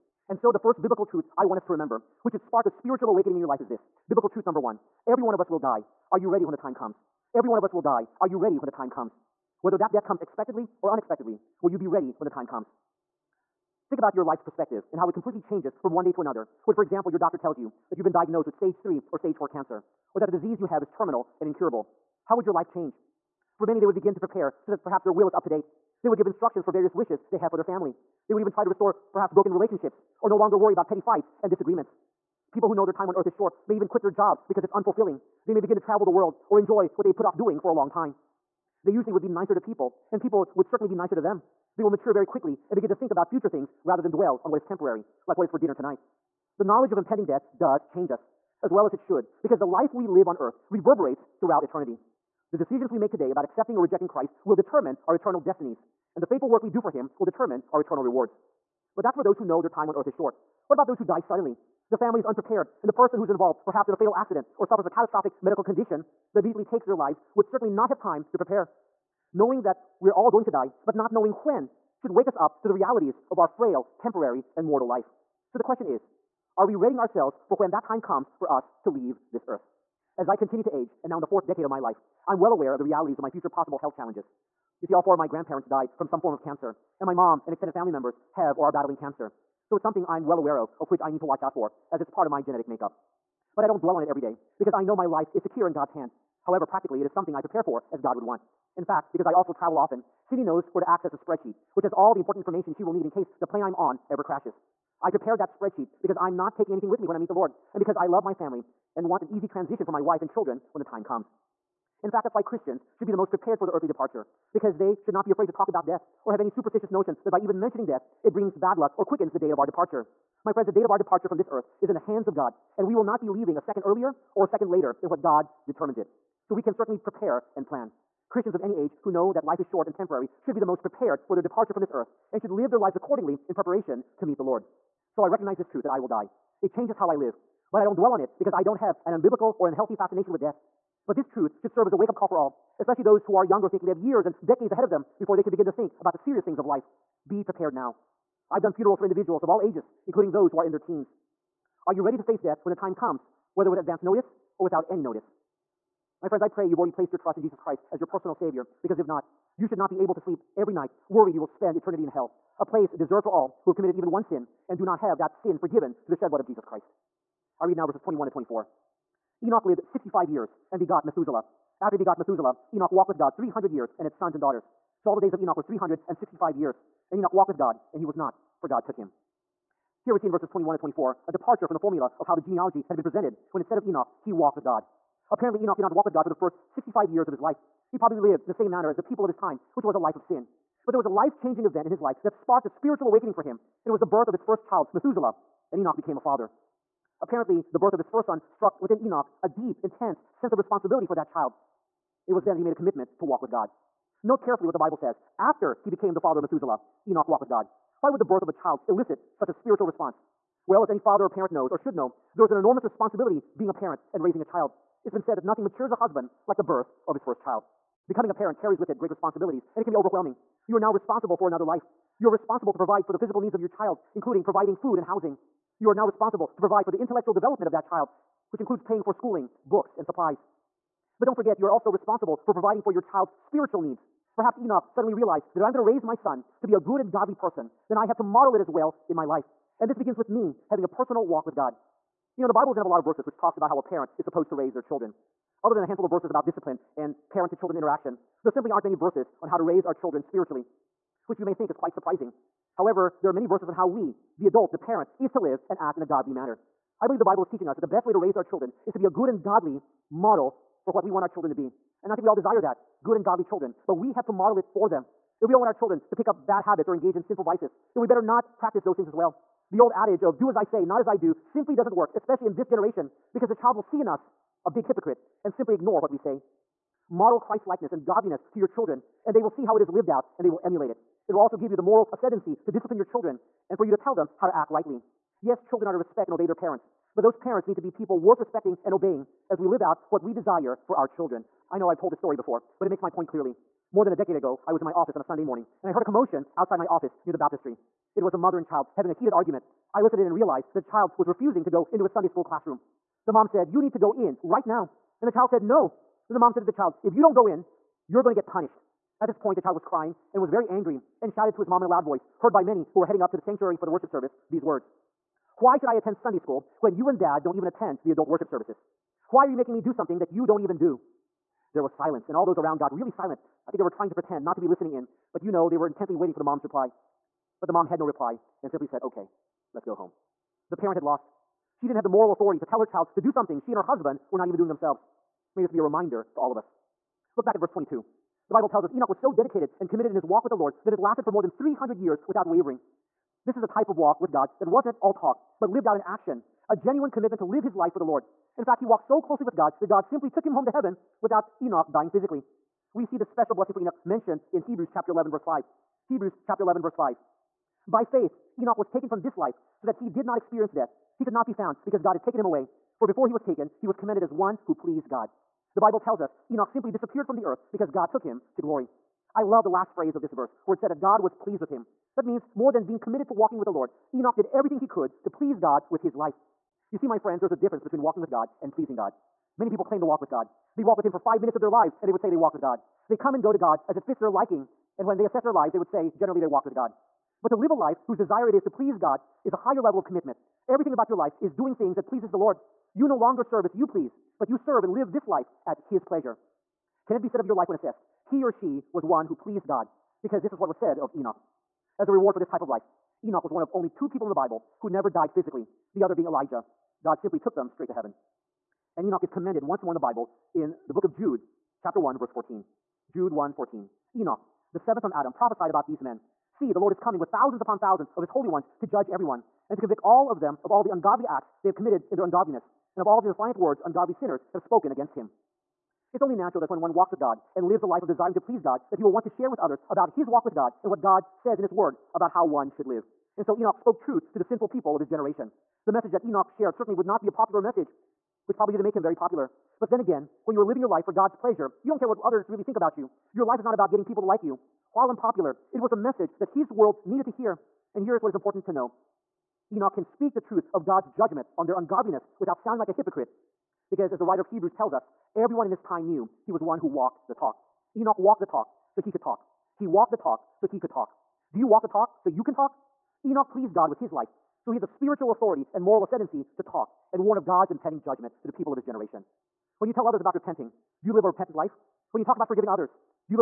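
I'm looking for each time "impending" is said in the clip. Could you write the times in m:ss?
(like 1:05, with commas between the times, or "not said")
0:46, 7:47.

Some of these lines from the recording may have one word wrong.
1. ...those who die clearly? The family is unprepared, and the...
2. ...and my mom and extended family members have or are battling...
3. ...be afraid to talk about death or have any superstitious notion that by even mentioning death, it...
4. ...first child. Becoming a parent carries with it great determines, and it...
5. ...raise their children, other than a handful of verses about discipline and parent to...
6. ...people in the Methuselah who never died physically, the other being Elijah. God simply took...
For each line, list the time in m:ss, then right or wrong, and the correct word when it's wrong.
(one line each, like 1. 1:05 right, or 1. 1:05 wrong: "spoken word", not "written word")
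1. 1:00 wrong: "suddenly", not "clearly"
2. 1:27 right
3. 1:55 right
4. 3:37 wrong: "responsibilities", not "determines"
5. 4:04 right
6. 6:44 wrong: "Bible", not "Methuselah".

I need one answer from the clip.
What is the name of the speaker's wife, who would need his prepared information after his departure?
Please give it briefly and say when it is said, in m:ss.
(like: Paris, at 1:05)
Cindy, at 1:40.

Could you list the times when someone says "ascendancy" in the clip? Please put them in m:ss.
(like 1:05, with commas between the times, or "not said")
4:42, 7:46.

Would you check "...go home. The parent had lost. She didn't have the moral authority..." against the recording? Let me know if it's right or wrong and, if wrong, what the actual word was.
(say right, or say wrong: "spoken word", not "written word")
right.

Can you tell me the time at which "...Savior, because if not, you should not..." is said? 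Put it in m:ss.
2:38.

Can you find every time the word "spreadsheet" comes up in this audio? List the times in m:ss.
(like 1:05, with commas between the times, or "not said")
1:41, 1:45.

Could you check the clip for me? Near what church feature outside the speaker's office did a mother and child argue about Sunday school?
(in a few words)
the baptistry.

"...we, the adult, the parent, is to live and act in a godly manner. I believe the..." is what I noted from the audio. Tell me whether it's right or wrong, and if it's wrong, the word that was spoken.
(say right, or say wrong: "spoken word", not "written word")
right.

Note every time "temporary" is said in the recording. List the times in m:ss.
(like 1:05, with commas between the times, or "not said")
0:44, 1:13, 2:09.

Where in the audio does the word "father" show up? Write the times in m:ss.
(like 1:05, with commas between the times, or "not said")
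3:16, 3:26, 3:30.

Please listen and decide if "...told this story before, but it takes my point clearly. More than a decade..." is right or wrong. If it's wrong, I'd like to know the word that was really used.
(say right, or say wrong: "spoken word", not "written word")
wrong: "makes", not "takes".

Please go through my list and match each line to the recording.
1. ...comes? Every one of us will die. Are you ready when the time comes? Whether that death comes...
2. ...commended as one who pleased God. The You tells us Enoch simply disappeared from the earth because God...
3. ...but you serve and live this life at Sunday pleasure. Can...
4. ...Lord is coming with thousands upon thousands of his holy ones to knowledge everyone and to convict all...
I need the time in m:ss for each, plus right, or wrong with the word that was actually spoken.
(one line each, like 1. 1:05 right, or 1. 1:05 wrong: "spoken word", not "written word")
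1. 0:06 right
2. 6:03 wrong: "Bible", not "You"
3. 6:34 wrong: "His", not "Sunday"
4. 6:56 wrong: "judge", not "knowledge".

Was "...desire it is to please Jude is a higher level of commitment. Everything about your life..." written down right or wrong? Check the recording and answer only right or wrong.
wrong.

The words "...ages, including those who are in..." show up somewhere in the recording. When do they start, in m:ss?
2:29.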